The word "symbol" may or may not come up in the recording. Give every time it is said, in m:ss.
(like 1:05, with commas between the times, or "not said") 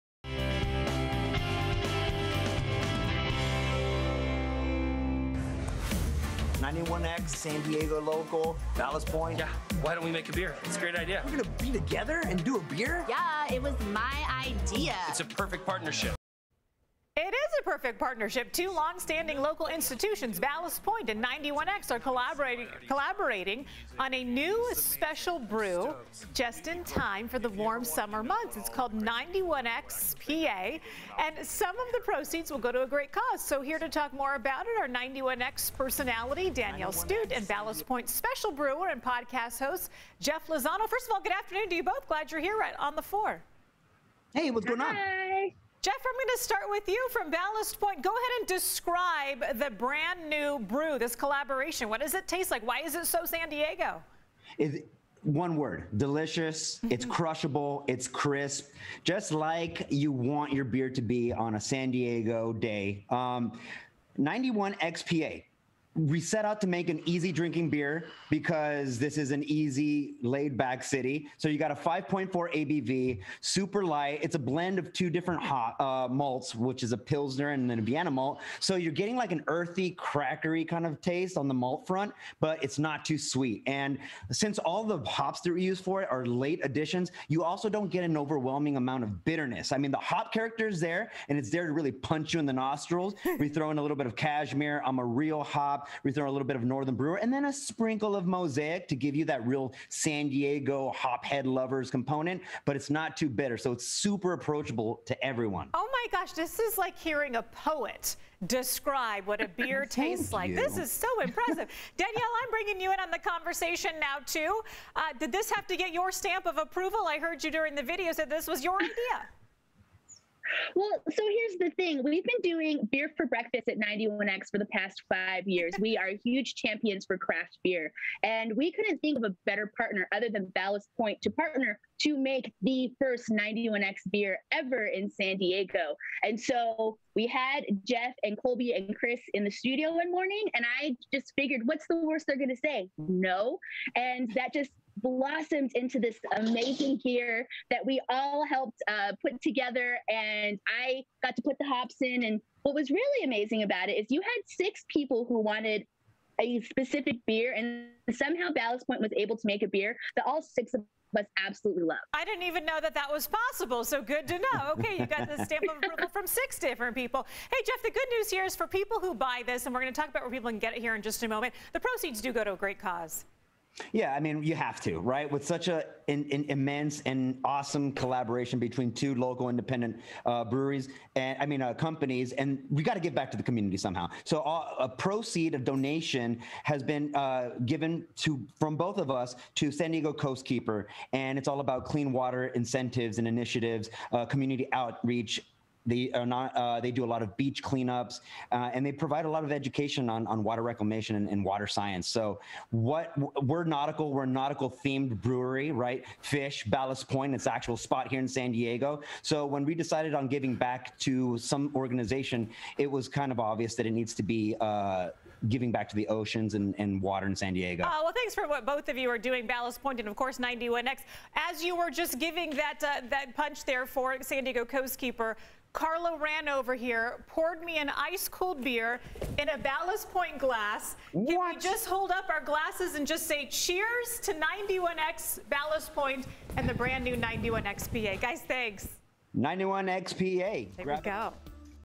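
not said.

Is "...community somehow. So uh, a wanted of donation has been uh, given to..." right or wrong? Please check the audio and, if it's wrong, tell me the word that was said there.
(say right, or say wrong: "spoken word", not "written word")
wrong: "proceed", not "wanted".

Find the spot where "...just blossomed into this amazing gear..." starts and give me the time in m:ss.
2:24.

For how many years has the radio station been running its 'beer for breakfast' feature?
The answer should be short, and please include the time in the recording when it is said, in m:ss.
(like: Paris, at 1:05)
5, at 2:05.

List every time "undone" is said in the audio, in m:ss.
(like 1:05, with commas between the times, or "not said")
not said.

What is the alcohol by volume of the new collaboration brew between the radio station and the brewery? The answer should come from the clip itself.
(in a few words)
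5.4.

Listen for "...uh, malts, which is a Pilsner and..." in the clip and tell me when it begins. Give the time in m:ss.
1:15.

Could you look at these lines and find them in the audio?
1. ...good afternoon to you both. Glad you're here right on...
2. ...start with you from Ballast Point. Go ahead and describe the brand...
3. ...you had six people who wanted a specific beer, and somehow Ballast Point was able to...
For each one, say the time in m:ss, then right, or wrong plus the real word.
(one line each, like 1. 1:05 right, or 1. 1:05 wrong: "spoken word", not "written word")
1. 0:41 right
2. 0:46 right
3. 2:34 right.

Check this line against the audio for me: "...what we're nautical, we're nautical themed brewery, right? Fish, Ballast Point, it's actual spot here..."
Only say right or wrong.
right.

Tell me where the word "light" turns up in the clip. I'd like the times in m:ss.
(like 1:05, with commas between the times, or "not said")
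1:13.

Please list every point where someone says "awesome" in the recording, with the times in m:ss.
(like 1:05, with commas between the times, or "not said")
2:57.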